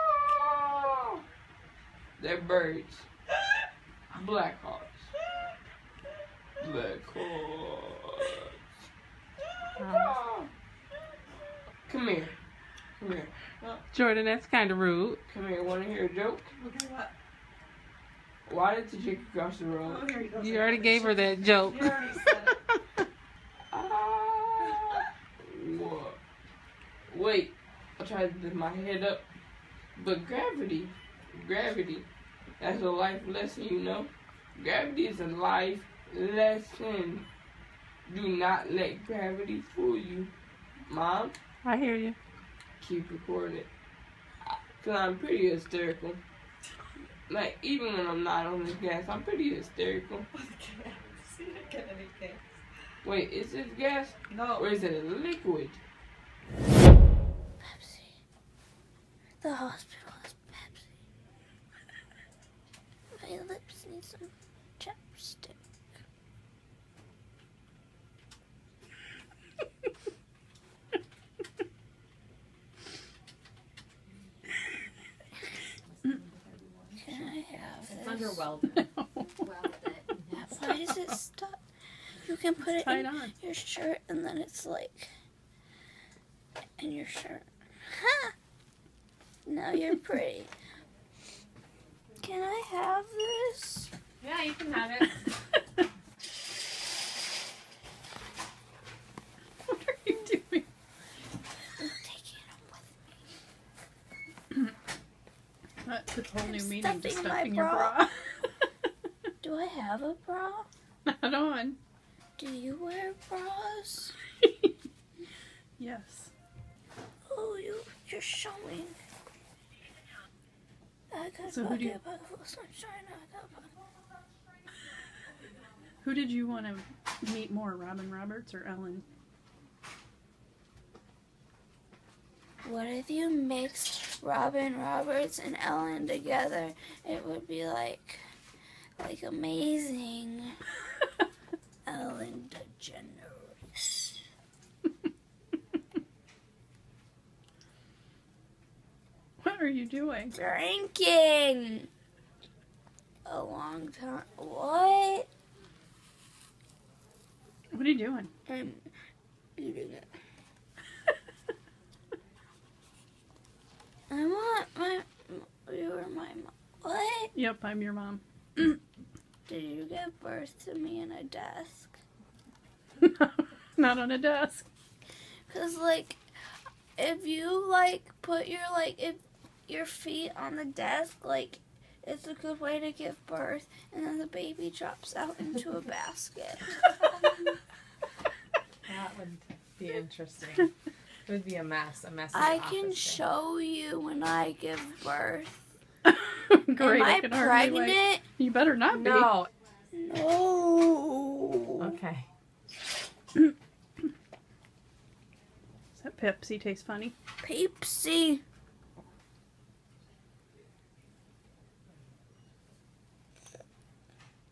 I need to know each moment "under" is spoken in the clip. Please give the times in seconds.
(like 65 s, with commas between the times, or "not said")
78 s.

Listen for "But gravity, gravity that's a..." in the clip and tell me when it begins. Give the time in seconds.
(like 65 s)
30 s.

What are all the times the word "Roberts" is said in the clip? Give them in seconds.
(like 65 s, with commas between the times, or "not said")
128 s, 134 s.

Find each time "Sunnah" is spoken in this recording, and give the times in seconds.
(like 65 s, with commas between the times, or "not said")
not said.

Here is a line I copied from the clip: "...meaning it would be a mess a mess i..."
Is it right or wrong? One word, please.
wrong.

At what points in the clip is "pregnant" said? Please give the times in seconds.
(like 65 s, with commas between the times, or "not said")
197 s.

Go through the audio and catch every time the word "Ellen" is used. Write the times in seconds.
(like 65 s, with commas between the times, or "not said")
128 s, 135 s, 141 s.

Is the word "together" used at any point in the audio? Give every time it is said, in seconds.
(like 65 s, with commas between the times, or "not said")
136 s.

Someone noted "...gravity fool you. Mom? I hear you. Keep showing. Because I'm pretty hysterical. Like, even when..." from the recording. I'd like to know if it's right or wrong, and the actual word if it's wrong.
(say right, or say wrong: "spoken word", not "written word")
wrong: "recording", not "showing".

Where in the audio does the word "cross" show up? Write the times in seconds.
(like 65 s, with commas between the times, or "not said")
19 s.